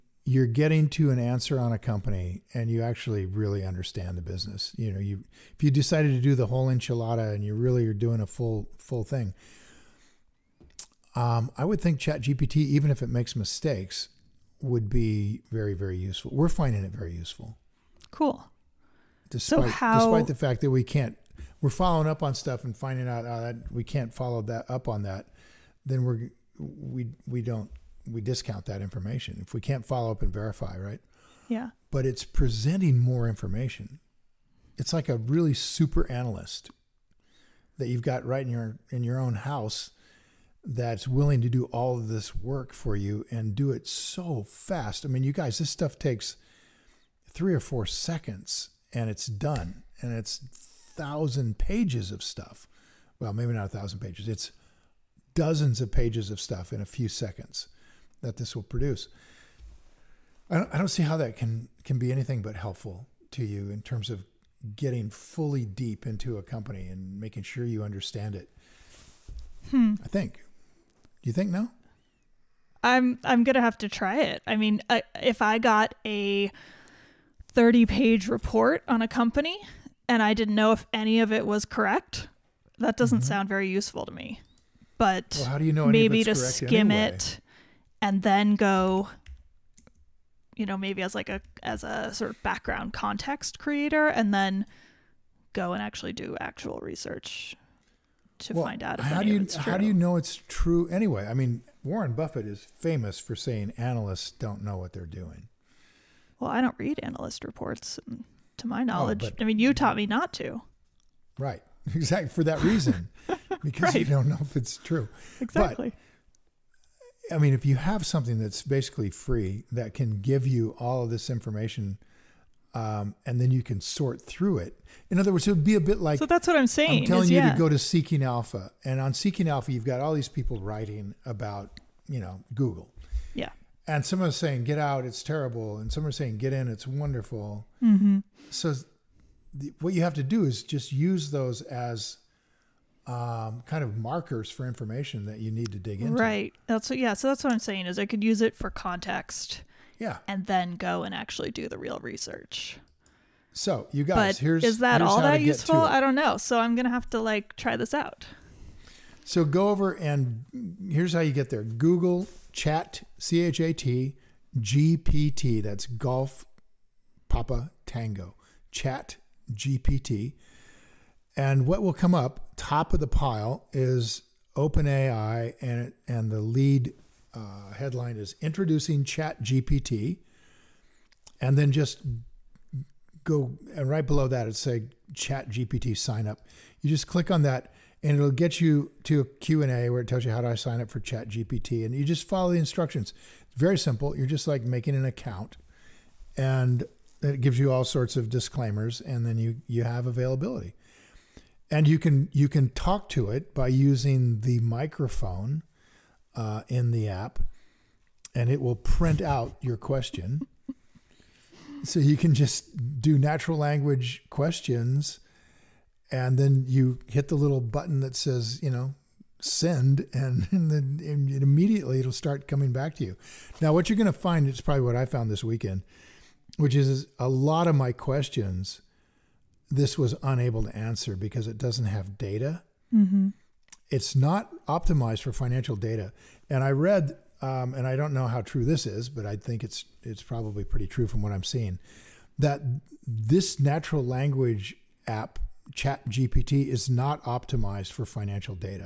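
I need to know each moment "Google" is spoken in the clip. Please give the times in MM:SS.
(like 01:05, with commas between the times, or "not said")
02:12, 02:41.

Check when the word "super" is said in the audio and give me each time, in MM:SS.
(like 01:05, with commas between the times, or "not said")
00:35.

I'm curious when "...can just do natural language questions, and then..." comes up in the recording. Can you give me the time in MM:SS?
03:32.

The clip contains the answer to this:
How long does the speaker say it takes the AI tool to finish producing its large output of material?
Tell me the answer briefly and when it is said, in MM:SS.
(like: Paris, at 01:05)
3 or 4 seconds, at 00:47.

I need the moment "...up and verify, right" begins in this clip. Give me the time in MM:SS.
00:30.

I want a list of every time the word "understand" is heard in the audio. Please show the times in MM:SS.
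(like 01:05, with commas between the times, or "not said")
00:03, 01:07.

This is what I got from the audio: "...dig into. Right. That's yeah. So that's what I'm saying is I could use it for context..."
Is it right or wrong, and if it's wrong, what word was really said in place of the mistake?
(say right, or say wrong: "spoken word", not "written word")
right.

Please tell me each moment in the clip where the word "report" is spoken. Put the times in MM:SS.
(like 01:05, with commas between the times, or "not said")
01:18, 01:47.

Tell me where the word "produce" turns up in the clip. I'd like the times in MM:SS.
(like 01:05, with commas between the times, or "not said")
00:58.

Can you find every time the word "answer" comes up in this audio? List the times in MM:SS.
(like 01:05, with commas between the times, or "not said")
00:01, 03:50.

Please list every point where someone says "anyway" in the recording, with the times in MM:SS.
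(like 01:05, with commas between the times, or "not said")
01:26, 01:40.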